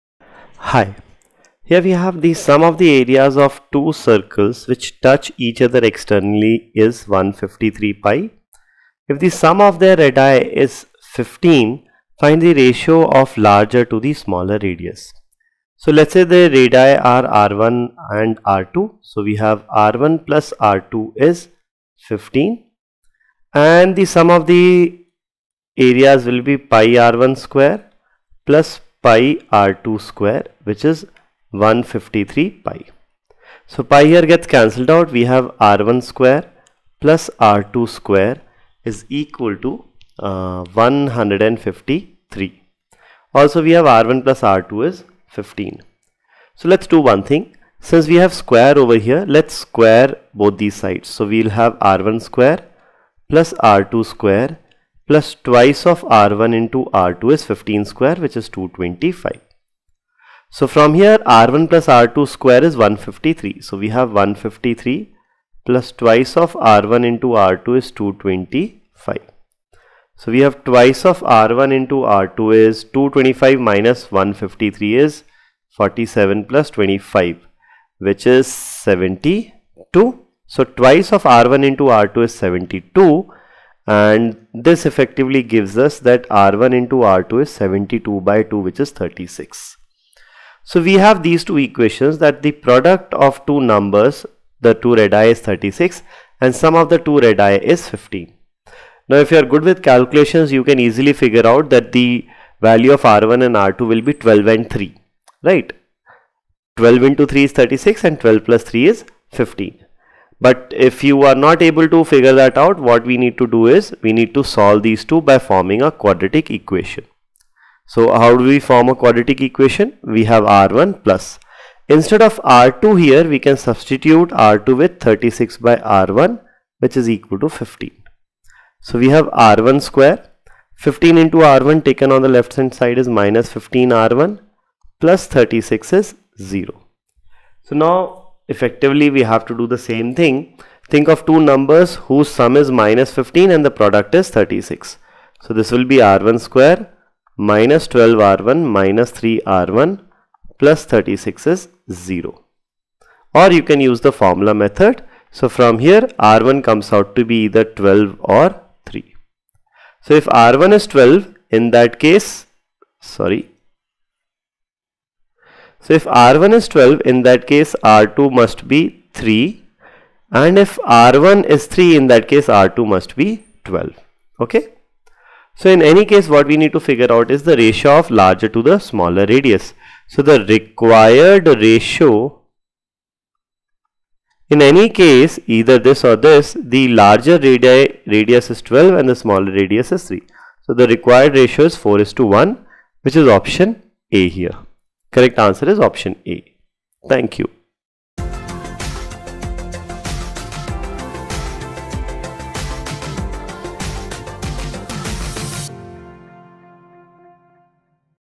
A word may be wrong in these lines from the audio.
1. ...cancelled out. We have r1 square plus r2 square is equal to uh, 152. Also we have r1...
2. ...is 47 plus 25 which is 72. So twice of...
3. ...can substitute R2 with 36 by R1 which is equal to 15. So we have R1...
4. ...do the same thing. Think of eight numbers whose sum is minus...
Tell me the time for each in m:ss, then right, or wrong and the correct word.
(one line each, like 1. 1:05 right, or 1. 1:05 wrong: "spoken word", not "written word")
1. 0:34 wrong: "153", not "152"
2. 1:14 right
3. 2:03 right
4. 2:19 wrong: "two", not "eight".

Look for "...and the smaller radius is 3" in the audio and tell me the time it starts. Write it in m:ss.
3:08.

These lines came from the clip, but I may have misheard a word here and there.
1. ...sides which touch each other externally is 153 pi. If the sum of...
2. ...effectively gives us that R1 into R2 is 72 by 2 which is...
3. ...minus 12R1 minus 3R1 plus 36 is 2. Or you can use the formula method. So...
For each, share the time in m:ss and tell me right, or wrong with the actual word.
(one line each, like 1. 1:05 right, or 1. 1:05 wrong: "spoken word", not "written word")
1. 0:03 wrong: "circles", not "sides"
2. 1:24 right
3. 2:27 wrong: "0", not "2".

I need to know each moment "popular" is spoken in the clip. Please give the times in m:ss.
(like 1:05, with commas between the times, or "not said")
not said.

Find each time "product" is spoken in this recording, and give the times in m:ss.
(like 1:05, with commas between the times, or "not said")
1:32, 2:23.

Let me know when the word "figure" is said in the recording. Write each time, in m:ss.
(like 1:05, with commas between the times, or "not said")
1:41, 1:52, 2:56.